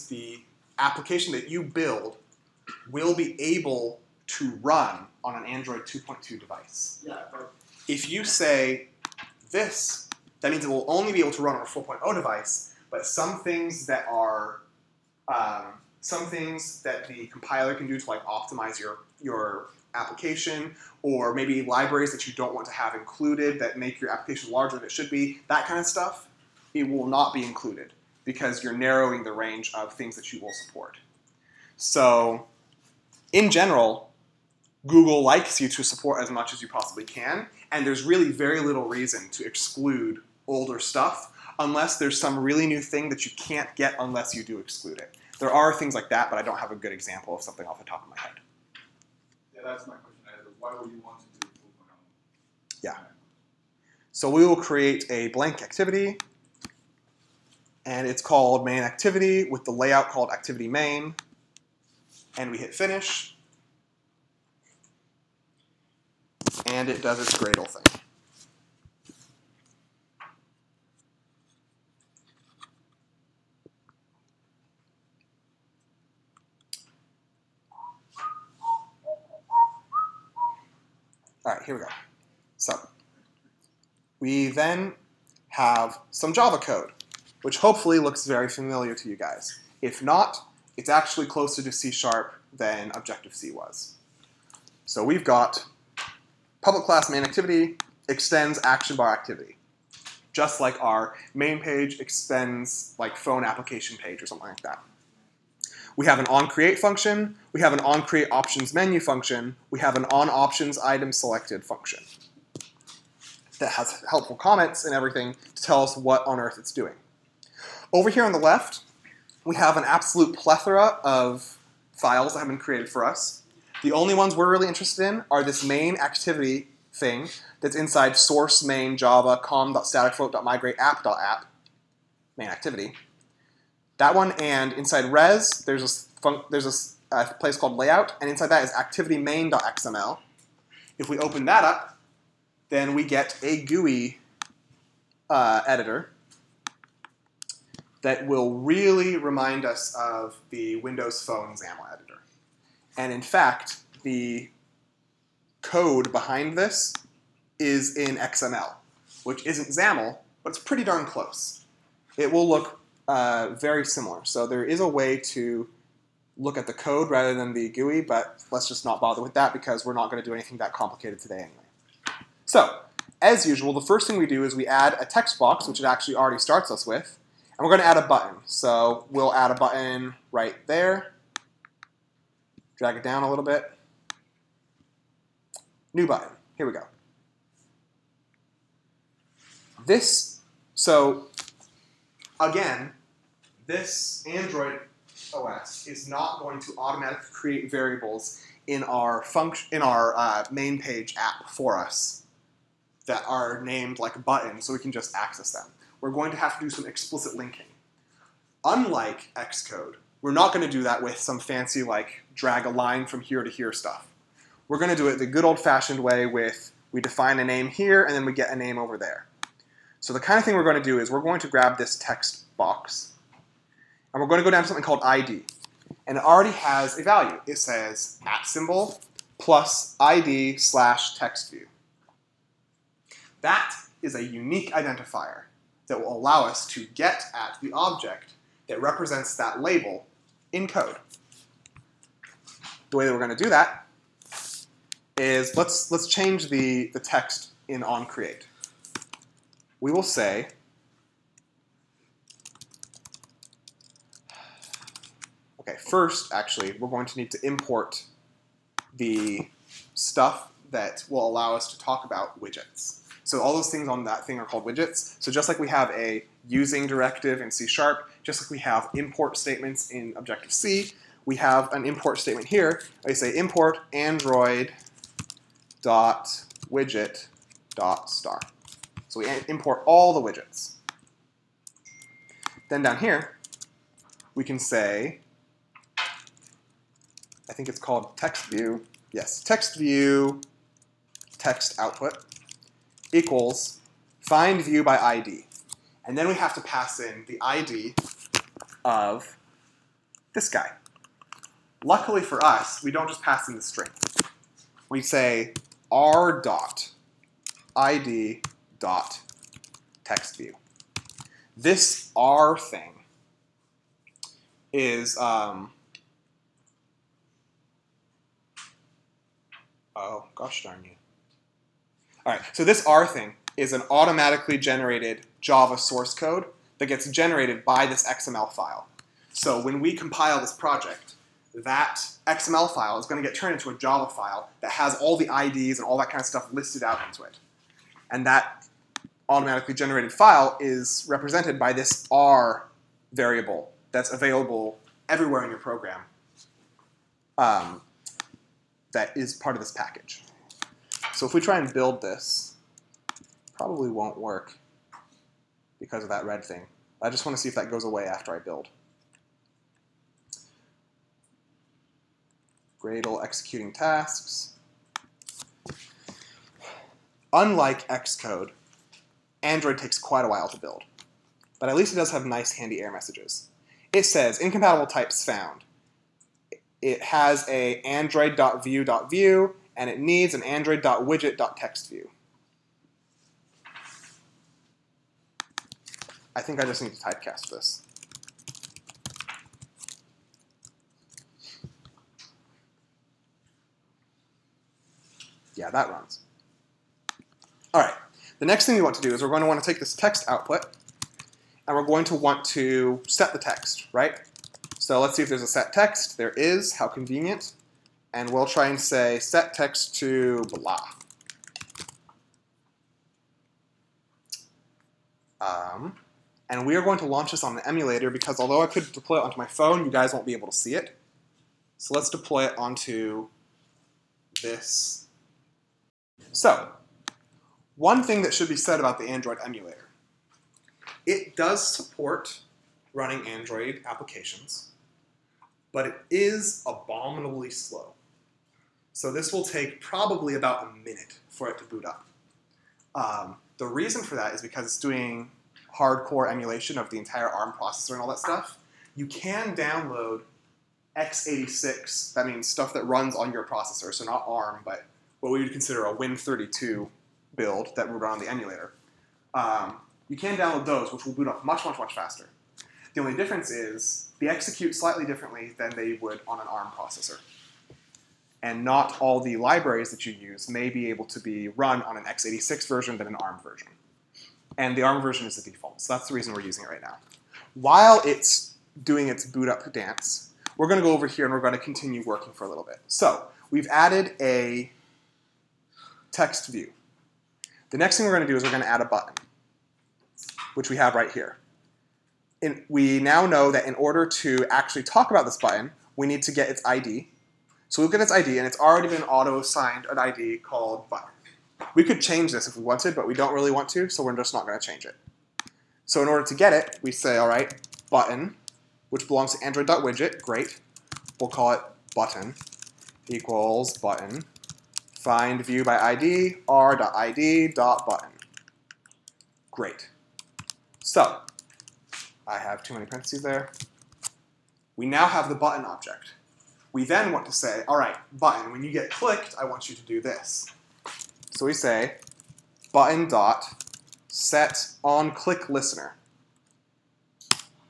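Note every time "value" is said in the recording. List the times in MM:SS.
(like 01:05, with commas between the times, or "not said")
03:47.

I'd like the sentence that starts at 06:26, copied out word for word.
I think I just need to typecast this.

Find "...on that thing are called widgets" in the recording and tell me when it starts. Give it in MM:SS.
04:23.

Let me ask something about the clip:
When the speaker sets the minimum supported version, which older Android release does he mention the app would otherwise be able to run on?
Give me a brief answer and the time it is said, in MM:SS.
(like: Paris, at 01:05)
Android 2.2, at 00:05.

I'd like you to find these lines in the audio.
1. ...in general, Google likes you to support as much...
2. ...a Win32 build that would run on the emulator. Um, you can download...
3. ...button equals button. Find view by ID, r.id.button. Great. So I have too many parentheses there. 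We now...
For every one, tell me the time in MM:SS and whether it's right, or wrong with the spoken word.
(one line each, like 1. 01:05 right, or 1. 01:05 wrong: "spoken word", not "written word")
1. 00:33 right
2. 07:35 right
3. 08:31 right.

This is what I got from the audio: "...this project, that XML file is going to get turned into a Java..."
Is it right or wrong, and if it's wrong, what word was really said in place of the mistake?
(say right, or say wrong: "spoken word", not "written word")
right.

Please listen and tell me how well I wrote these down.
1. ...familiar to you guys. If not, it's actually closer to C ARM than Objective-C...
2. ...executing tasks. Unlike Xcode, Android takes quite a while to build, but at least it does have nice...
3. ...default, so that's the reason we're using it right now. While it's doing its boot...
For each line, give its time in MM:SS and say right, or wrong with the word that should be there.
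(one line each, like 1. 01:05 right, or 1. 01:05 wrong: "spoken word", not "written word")
1. 01:28 wrong: "Sharp", not "ARM"
2. 06:03 right
3. 07:55 right.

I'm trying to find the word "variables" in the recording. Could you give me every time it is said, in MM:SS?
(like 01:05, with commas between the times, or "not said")
03:17, 05:43.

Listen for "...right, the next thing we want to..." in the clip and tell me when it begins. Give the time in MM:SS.
06:37.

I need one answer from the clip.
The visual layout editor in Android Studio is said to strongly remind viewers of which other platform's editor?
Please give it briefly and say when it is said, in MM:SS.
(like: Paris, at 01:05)
Windows Phone XAML editor, at 02:30.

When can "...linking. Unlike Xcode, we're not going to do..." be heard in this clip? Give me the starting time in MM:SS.
03:27.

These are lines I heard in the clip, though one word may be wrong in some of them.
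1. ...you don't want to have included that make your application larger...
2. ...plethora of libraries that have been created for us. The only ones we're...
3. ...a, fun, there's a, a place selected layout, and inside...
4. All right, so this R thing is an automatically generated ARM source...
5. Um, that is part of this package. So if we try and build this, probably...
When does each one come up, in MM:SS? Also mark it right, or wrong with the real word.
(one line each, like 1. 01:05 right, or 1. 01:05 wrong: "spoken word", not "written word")
1. 00:22 right
2. 02:00 wrong: "files", not "libraries"
3. 02:15 wrong: "called", not "selected"
4. 05:22 wrong: "Java", not "ARM"
5. 05:47 right.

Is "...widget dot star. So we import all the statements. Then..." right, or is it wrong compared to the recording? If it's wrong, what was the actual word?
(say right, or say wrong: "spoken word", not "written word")
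wrong: "widgets", not "statements".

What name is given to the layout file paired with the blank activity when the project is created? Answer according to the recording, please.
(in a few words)
activity main.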